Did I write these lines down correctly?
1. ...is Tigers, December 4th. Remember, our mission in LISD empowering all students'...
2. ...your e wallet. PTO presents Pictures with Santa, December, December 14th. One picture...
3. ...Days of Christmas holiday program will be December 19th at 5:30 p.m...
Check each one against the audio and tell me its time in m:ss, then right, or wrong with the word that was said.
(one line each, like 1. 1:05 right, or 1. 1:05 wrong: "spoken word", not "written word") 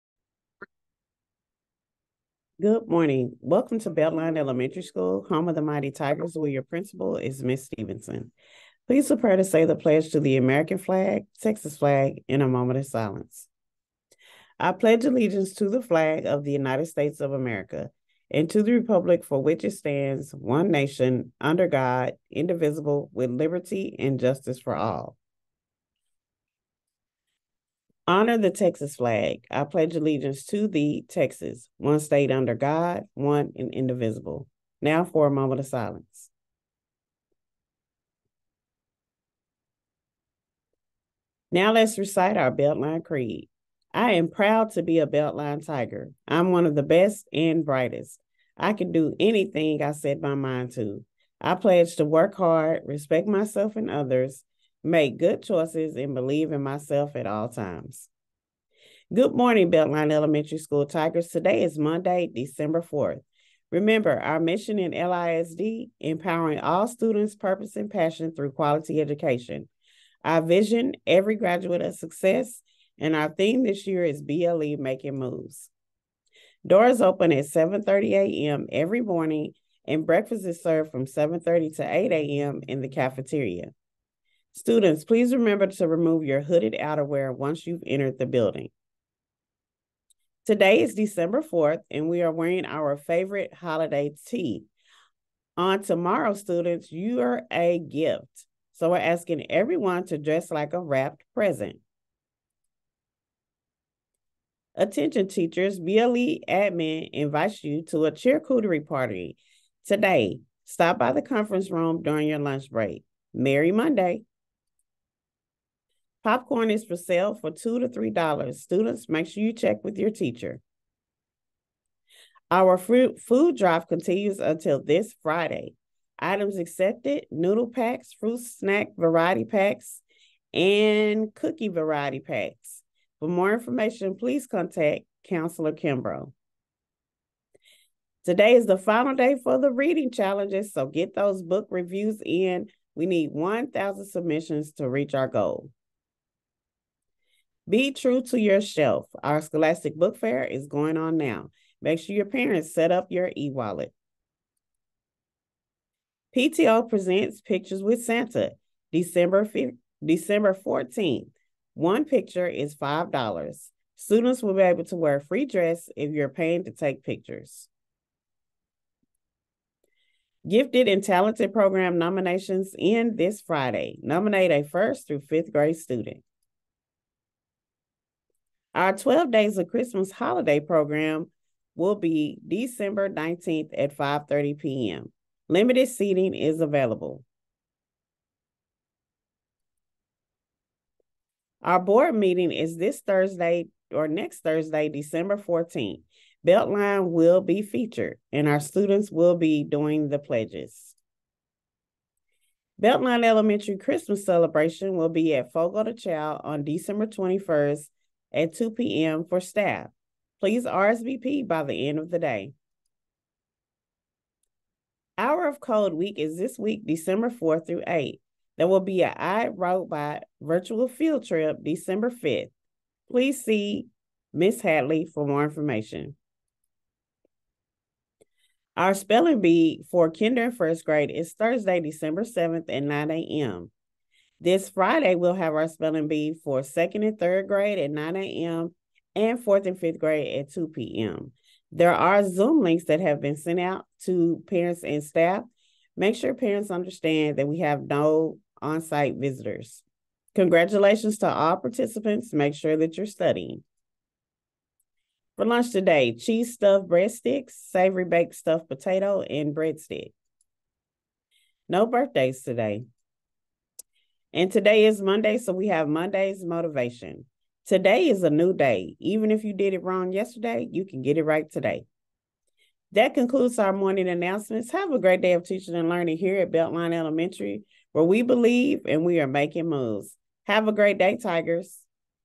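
1. 1:01 wrong: "Monday", not "Tigers"
2. 2:33 right
3. 2:59 right.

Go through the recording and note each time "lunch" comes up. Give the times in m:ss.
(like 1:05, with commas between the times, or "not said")
1:52, 4:15.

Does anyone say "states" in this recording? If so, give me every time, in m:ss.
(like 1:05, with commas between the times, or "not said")
0:16, 0:32.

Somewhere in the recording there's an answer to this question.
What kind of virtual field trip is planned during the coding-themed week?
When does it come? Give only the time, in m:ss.
3:39.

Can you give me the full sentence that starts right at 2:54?
Nominate a first through fifth grade student.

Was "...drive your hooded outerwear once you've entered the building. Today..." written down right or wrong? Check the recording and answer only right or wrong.
wrong.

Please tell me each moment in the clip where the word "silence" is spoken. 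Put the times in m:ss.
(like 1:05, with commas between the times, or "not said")
0:12, 0:35.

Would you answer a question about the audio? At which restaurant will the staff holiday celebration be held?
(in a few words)
Fogo de Chão.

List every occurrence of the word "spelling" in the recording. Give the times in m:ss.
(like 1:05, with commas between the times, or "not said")
3:48, 3:55.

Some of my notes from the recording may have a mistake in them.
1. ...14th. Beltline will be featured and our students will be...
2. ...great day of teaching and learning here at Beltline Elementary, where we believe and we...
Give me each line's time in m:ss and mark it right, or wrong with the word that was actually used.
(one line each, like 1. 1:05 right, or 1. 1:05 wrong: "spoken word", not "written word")
1. 3:15 right
2. 4:34 right.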